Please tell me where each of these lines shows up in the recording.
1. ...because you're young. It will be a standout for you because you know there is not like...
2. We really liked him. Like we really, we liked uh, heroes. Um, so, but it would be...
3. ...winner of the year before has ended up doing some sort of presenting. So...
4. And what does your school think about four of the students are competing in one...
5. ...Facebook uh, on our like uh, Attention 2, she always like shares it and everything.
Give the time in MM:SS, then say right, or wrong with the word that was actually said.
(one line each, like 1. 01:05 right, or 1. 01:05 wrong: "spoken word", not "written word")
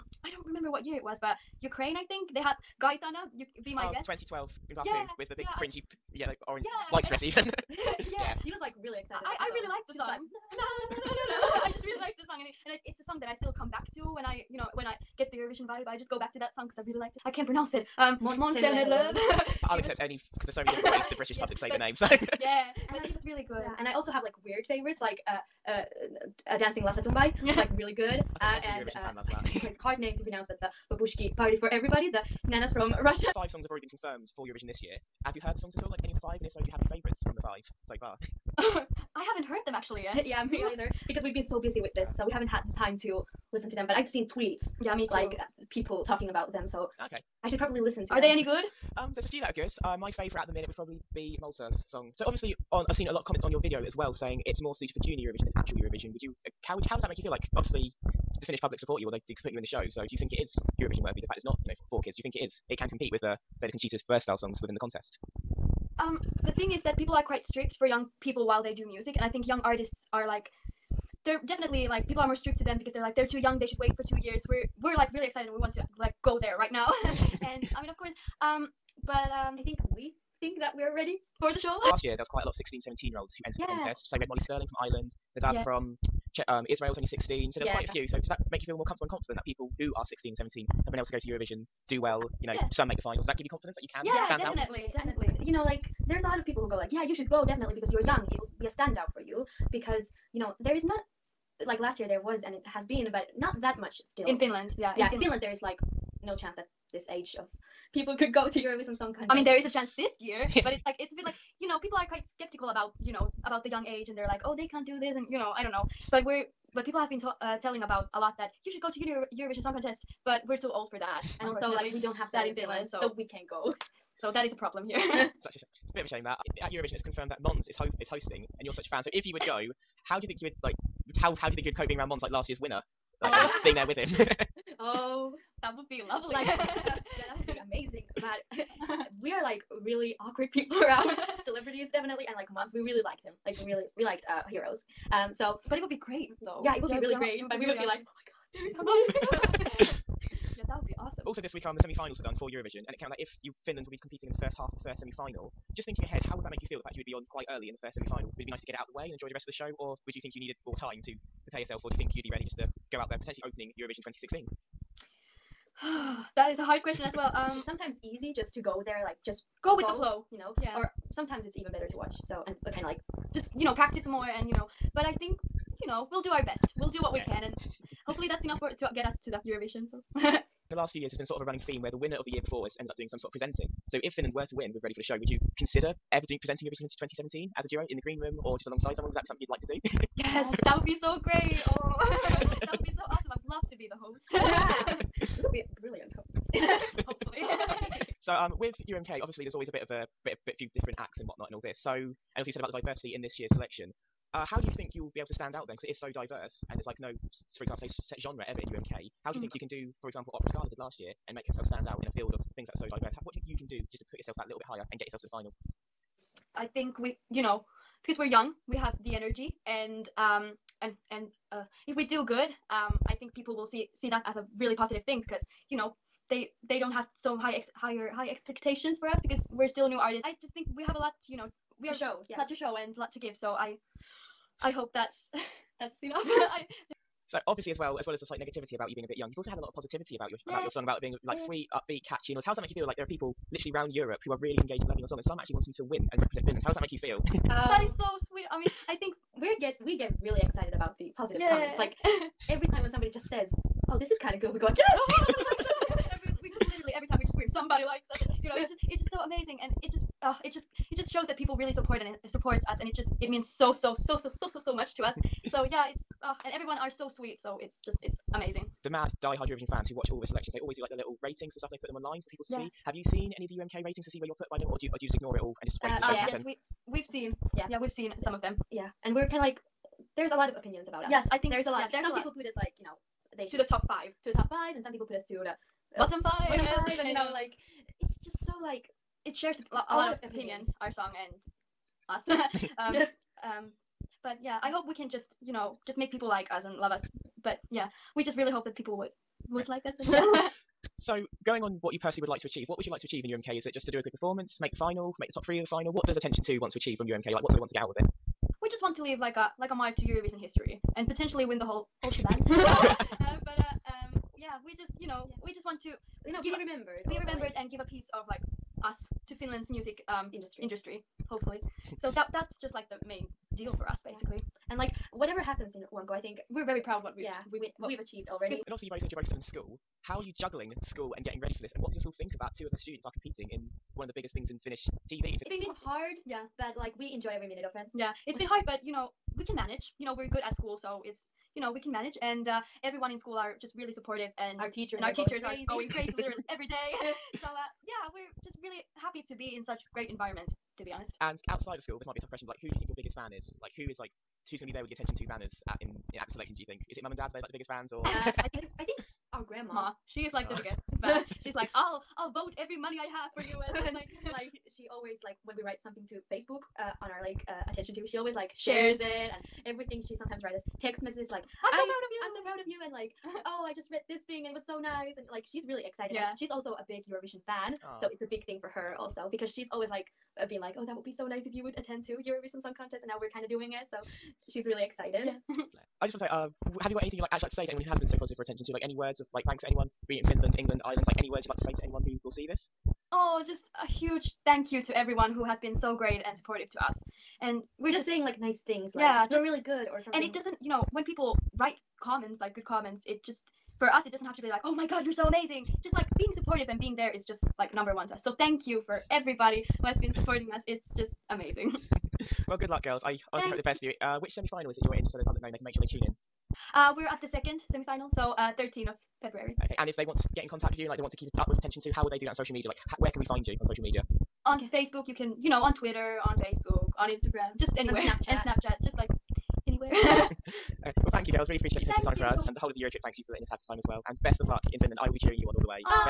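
1. 01:37 right
2. 02:22 right
3. 03:01 right
4. 05:31 wrong: "two", not "four"
5. 06:06 right.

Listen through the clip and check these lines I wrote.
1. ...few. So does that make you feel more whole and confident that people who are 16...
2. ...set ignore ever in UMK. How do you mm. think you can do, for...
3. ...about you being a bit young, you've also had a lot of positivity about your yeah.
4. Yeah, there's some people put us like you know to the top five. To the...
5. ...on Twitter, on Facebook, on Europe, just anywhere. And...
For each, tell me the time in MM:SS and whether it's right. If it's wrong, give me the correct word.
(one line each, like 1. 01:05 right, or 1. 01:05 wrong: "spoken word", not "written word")
1. 01:27 wrong: "comfortable", not "whole"
2. 03:27 wrong: "genre", not "ignore"
3. 03:58 right
4. 04:41 right
5. 07:05 wrong: "Instagram", not "Europe".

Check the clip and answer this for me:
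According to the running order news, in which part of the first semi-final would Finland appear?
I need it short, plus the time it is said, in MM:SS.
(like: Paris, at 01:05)
First half, at 02:34.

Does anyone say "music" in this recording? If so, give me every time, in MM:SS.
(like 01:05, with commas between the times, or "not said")
01:08, 05:19.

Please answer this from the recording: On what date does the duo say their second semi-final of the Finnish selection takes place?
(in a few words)
13 February.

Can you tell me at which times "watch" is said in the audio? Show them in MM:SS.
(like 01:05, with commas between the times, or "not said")
02:51, 04:29.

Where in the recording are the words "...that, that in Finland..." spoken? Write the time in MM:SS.
02:02.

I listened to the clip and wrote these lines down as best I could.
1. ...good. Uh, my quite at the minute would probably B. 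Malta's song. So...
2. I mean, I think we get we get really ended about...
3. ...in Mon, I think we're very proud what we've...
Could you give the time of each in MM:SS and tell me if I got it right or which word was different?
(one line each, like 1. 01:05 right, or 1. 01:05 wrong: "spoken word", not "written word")
1. 00:49 wrong: "favorite", not "quite"
2. 04:08 wrong: "excited", not "ended"
3. 05:25 wrong: "UMK", not "Mon".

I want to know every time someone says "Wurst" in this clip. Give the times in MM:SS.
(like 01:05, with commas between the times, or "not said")
01:04.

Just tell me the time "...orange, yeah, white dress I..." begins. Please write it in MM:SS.
00:06.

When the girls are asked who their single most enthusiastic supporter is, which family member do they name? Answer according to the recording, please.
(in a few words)
Grandma.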